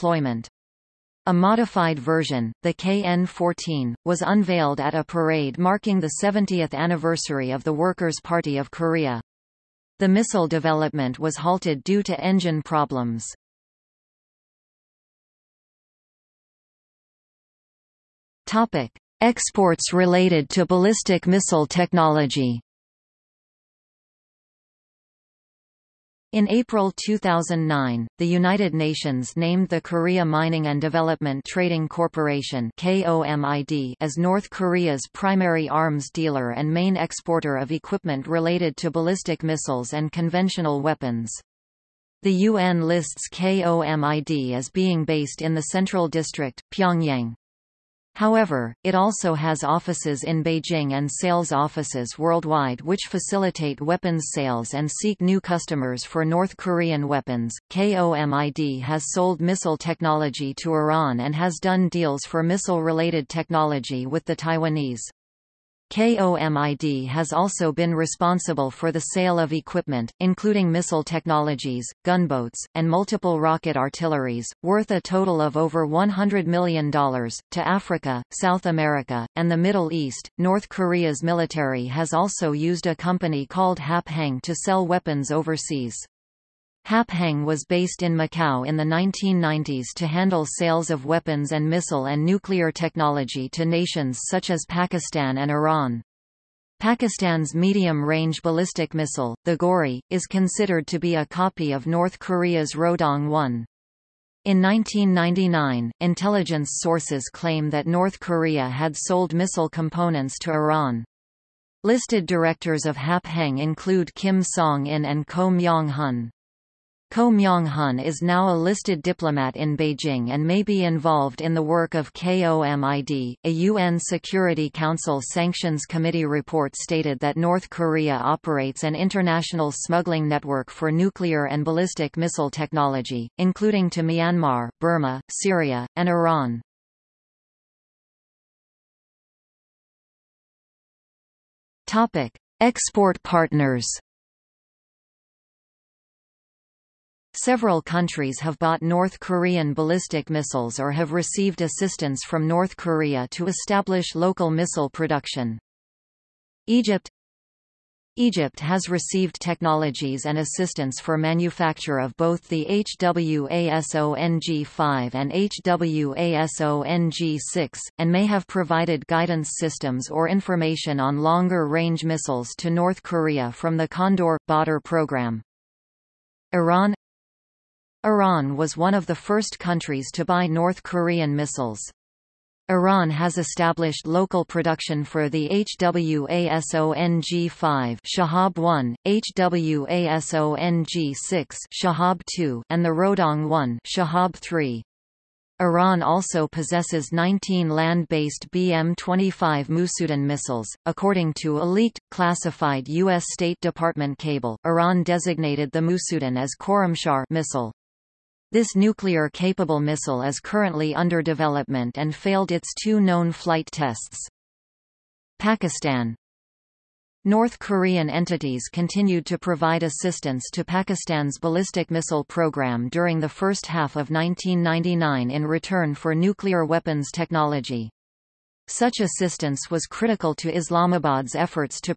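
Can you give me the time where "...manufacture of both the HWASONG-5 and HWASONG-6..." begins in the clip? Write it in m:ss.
2:41.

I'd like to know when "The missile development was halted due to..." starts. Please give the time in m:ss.
0:09.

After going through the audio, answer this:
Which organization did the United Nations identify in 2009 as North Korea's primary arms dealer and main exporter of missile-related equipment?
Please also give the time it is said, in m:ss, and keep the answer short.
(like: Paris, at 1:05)
Korea Mining and Development Trading Corporation, at 0:29.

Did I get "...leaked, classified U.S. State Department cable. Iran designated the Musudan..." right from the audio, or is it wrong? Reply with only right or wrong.
right.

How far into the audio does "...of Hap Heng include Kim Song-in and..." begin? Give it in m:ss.
1:52.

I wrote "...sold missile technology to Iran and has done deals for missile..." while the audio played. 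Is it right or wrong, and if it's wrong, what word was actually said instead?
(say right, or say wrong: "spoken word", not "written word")
right.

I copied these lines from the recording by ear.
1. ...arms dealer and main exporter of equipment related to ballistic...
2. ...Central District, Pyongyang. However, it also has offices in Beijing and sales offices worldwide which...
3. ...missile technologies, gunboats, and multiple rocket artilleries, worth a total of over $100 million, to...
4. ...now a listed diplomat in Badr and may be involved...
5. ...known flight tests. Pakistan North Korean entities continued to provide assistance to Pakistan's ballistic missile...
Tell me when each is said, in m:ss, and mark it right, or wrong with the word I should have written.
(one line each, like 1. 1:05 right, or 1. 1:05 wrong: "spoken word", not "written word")
1. 0:35 right
2. 0:45 right
3. 1:10 right
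4. 1:58 wrong: "Beijing", not "Badr"
5. 3:32 right.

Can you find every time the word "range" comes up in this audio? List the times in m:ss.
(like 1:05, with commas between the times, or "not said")
1:37, 2:51.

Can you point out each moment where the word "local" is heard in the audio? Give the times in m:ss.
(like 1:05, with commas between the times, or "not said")
2:34, 3:04.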